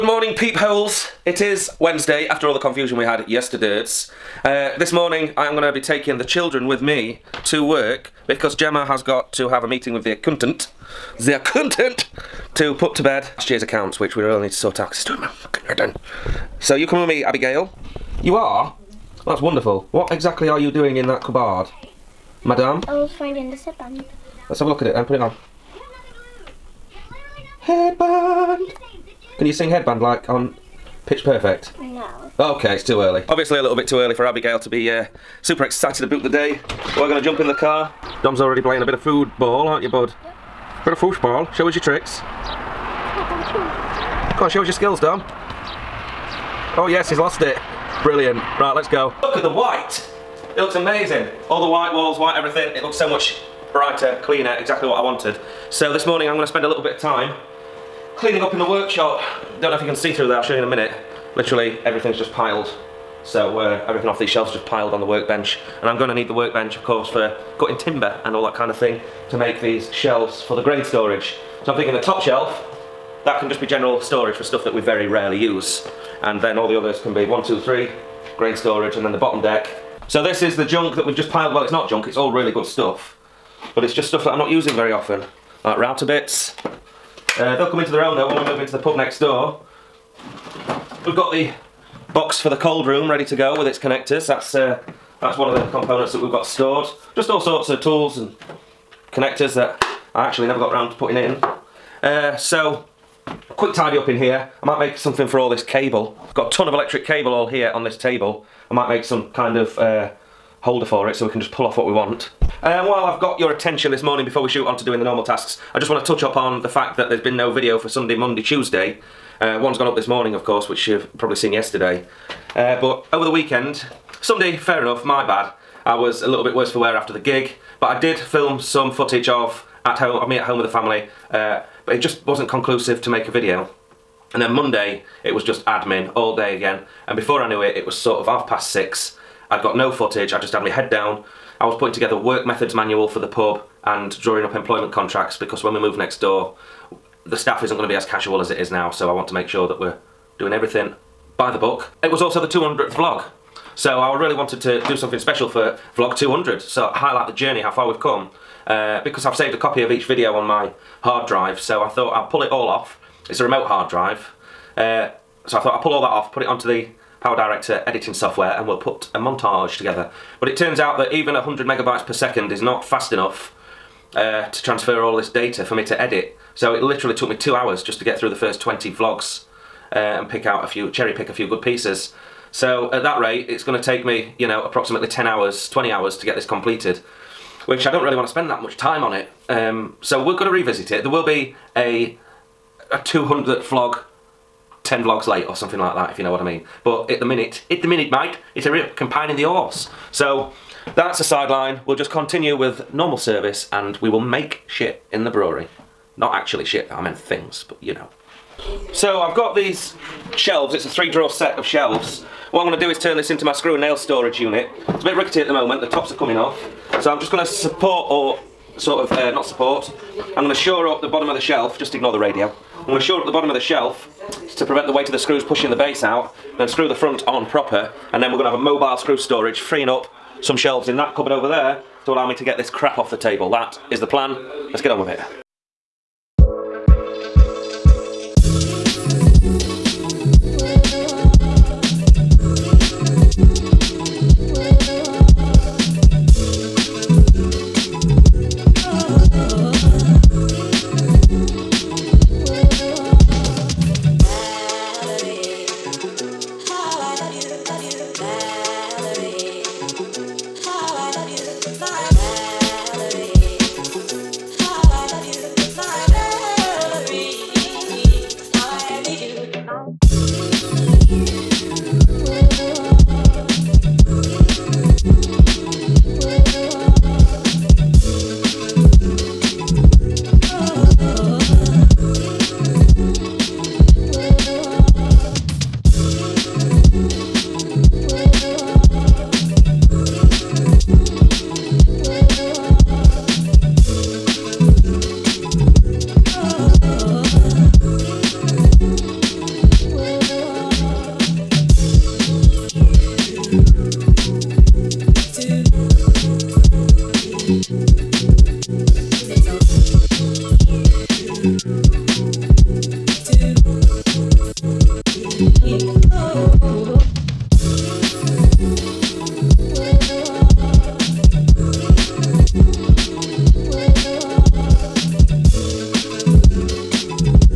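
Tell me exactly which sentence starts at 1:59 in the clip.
Uh, one's gone up this morning, of course, which you've probably seen yesterday.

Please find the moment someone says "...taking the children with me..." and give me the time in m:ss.
0:05.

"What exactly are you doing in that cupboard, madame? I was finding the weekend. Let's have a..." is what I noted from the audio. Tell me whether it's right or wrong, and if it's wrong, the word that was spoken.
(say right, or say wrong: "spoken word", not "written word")
wrong: "headband", not "weekend".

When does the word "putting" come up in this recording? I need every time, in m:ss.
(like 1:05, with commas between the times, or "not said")
1:40, 2:21.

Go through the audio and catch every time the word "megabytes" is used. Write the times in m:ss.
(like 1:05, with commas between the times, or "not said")
2:51.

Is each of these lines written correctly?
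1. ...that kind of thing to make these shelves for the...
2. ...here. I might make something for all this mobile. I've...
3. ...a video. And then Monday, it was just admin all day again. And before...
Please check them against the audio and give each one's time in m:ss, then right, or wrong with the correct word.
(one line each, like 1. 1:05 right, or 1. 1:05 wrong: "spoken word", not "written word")
1. 1:08 right
2. 1:44 wrong: "cable", not "mobile"
3. 2:13 right.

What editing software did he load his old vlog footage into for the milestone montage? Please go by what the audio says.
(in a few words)
PowerDirector.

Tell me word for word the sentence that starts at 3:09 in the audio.
Um, so we're going to revisit it.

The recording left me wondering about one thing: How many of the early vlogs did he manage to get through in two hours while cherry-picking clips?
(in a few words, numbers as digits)
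20.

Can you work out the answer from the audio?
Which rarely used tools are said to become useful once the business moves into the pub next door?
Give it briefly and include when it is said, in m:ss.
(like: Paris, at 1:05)
Router bits, at 1:25.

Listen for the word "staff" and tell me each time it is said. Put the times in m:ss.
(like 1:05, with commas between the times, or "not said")
2:27.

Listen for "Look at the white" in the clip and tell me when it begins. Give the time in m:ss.
0:49.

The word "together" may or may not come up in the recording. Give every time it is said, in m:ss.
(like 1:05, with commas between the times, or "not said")
2:21, 2:49.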